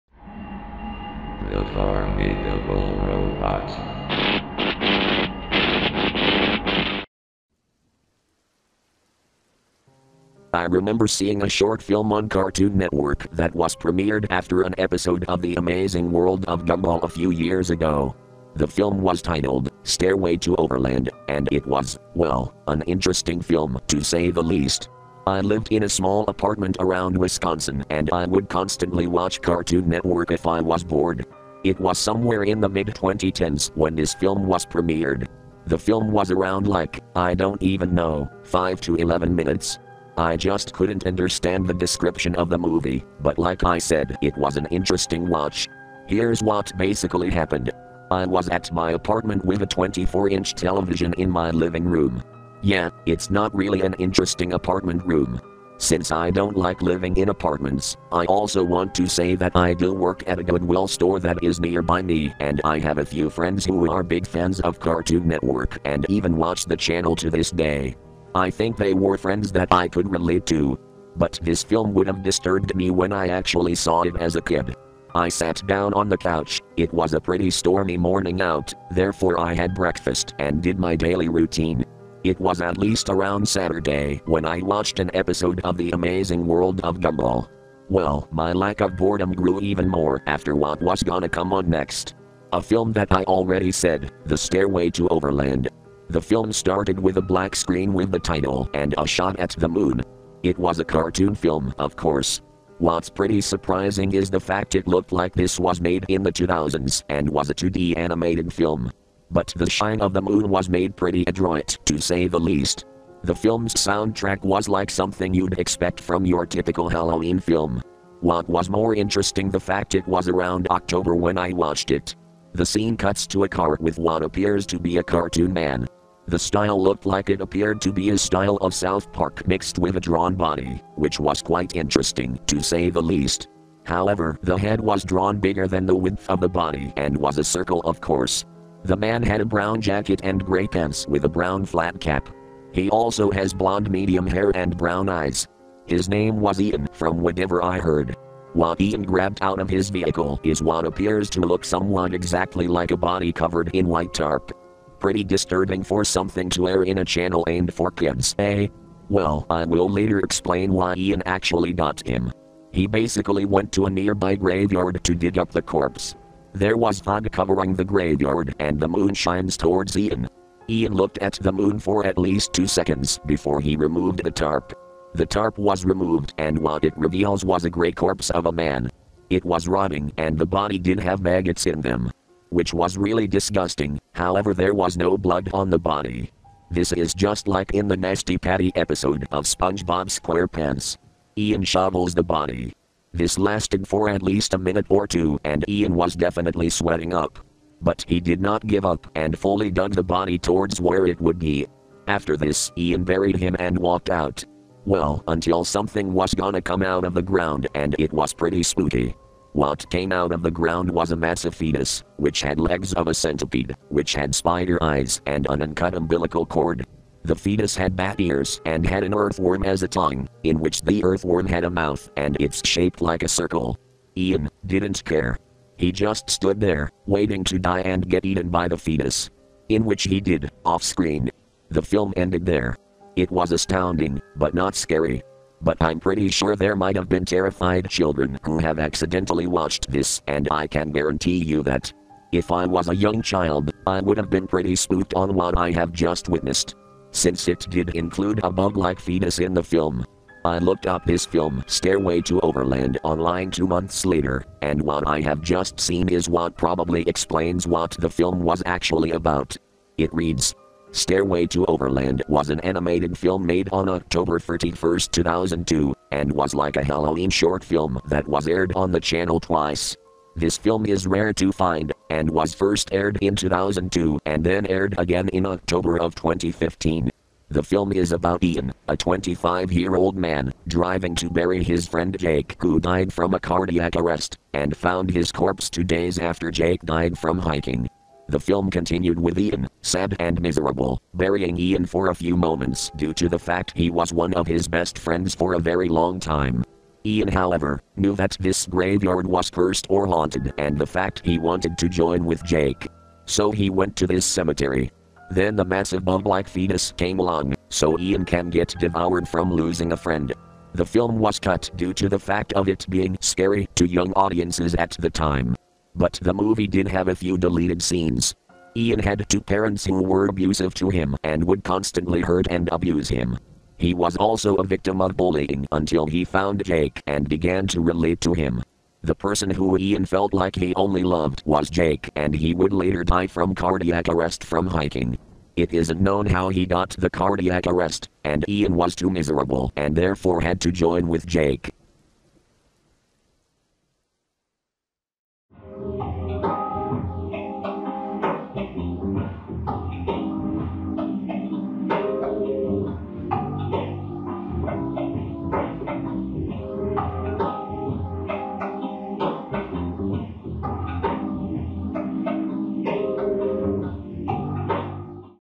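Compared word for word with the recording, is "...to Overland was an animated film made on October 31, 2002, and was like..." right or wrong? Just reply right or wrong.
right.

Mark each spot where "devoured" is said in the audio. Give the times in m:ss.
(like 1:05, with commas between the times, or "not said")
5:08.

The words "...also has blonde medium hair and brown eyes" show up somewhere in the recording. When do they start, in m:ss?
2:22.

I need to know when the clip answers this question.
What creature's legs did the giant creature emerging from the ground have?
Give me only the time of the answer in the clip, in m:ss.
3:33.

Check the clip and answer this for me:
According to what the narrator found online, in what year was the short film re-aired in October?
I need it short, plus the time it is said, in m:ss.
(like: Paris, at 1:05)
2015, at 4:36.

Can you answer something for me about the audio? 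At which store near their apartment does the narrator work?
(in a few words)
Goodwill.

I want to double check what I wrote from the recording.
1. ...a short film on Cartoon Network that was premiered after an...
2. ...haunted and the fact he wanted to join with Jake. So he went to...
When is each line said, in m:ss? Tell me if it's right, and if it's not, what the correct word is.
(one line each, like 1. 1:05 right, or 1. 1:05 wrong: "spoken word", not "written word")
1. 0:11 right
2. 5:00 right.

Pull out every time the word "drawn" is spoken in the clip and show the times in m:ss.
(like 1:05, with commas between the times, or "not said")
2:09, 2:15.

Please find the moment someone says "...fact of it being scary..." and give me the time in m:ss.
5:12.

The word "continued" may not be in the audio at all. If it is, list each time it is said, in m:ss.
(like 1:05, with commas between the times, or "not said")
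4:48.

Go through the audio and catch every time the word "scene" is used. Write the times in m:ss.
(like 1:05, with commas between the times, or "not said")
2:02, 5:17.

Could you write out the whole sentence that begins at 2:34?
Pretty disturbing for something to air in a channel aimed for kids, eh?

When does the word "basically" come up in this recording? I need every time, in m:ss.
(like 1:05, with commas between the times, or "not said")
0:46, 2:42.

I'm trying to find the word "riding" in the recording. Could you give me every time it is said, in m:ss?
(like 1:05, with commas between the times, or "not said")
not said.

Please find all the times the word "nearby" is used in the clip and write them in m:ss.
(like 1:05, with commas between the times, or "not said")
1:01, 2:43.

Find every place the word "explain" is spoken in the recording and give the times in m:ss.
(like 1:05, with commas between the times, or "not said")
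2:40, 4:17.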